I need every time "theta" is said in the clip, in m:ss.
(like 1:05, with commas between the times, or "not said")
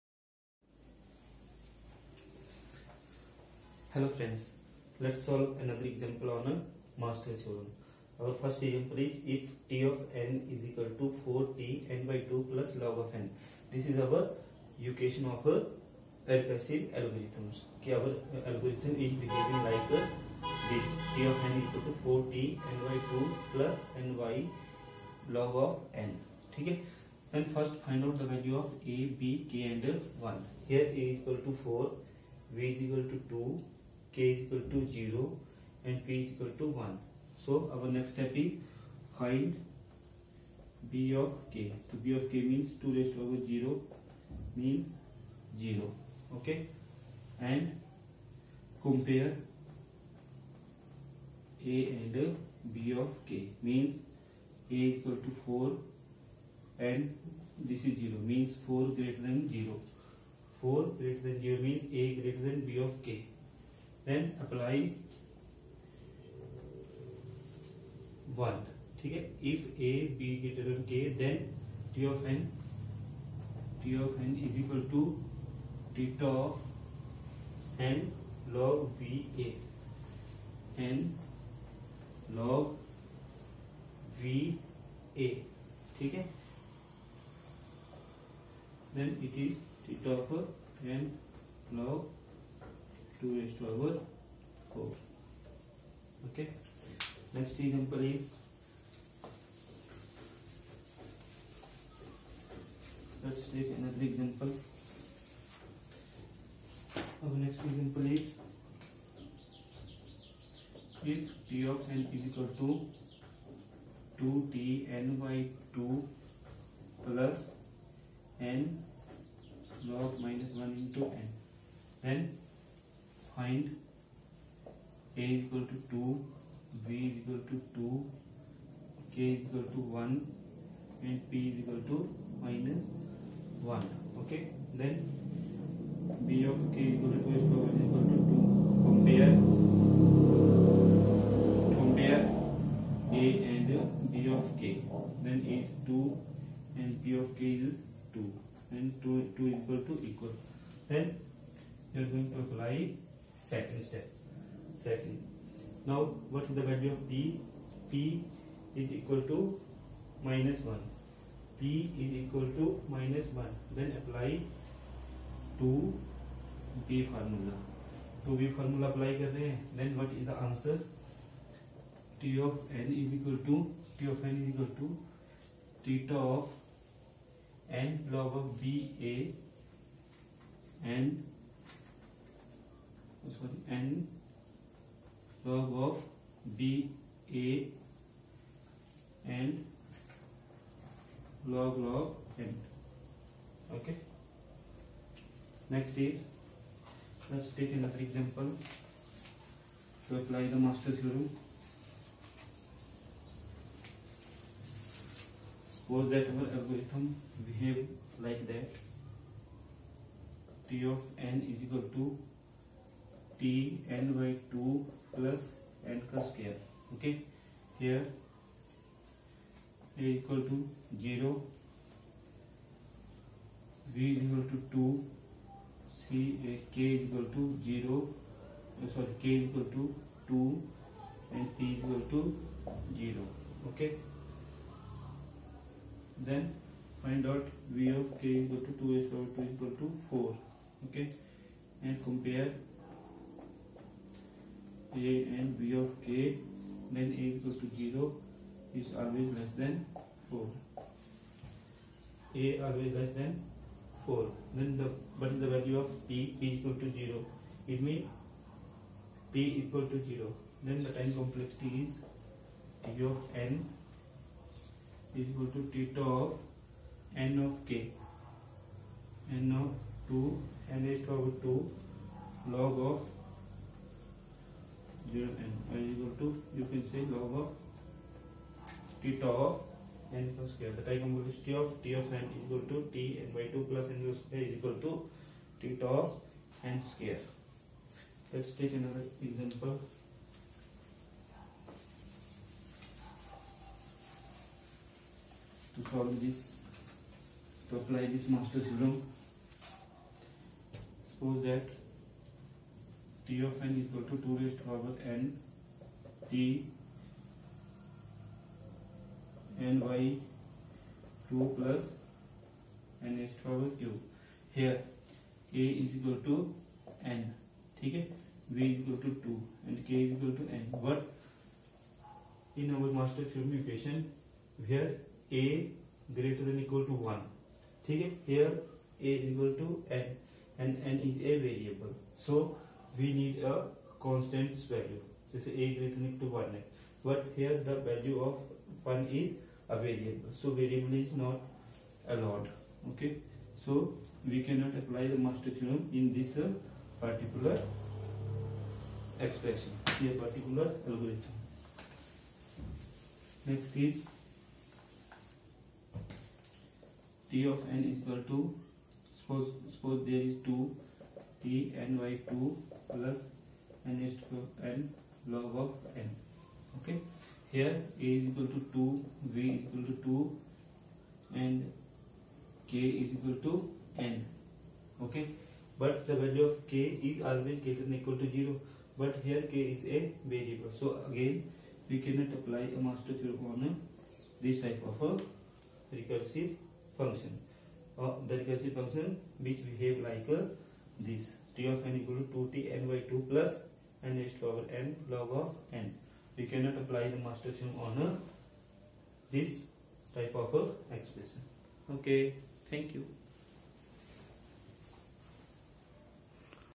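2:55, 4:25.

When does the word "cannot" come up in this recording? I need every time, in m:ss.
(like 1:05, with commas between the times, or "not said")
5:44, 6:22, 6:36.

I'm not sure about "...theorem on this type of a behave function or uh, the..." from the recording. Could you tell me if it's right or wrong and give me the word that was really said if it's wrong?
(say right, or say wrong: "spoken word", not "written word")
wrong: "recursive", not "behave".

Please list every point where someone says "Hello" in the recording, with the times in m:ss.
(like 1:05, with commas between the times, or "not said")
0:03.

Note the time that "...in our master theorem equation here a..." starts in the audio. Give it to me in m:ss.
5:22.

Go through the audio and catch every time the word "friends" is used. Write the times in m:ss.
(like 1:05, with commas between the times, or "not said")
0:04.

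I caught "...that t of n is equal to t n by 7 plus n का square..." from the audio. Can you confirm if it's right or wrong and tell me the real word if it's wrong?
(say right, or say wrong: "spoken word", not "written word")
wrong: "2", not "7".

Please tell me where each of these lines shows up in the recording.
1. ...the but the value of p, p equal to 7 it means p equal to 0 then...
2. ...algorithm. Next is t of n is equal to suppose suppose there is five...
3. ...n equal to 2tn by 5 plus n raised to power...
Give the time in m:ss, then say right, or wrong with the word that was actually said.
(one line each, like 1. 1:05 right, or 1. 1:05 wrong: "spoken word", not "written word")
1. 4:14 wrong: "0", not "7"
2. 5:50 wrong: "two", not "five"
3. 6:31 wrong: "2", not "5".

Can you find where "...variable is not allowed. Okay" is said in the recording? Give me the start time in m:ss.
5:40.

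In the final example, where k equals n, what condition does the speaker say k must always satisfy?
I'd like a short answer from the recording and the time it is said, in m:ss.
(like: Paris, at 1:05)
greater than or equal to 0, at 6:17.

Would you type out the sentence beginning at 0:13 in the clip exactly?
This is our equation of a recursive algorithms.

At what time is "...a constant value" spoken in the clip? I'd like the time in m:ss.
5:33.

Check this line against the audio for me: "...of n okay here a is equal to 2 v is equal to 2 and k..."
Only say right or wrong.
right.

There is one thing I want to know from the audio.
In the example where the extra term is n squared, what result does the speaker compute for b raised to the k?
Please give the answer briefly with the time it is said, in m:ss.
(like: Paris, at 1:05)
4, at 3:58.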